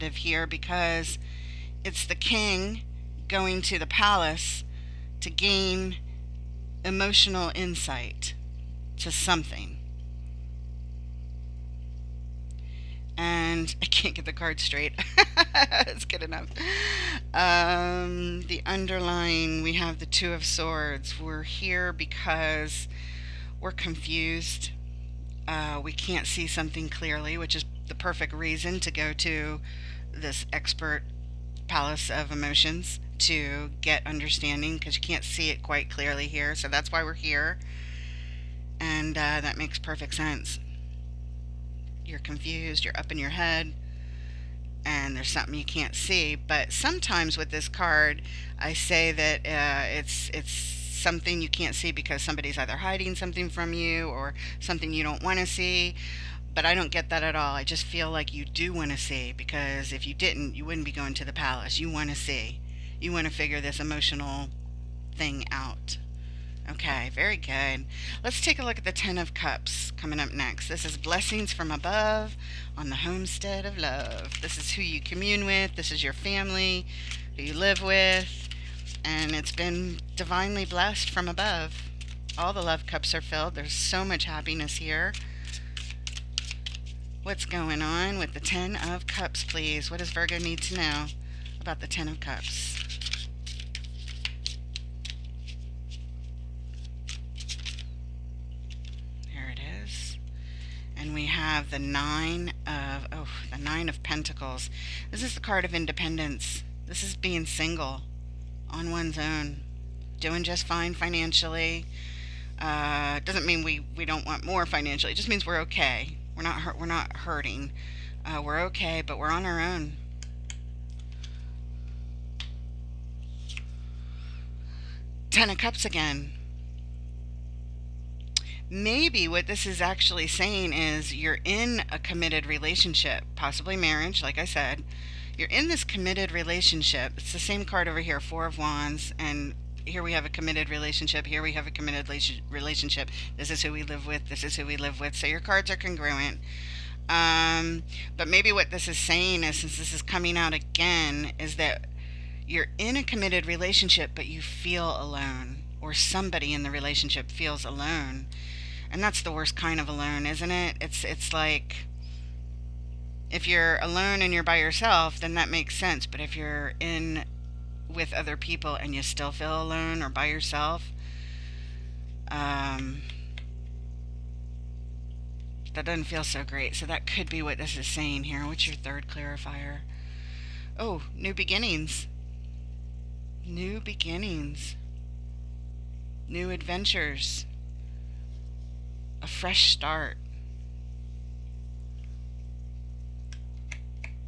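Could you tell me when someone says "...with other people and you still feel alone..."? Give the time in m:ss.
2:47.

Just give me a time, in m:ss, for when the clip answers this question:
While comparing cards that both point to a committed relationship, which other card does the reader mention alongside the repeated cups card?
2:18.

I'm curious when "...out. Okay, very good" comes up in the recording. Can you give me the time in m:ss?
1:05.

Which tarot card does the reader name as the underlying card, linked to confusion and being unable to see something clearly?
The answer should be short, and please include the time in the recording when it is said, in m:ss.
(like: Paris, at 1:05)
Two of Swords, at 0:20.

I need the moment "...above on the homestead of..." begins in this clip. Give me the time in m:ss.
1:11.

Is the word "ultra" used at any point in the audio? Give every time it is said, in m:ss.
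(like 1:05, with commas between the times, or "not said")
not said.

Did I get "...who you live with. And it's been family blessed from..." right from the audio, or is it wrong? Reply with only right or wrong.
wrong.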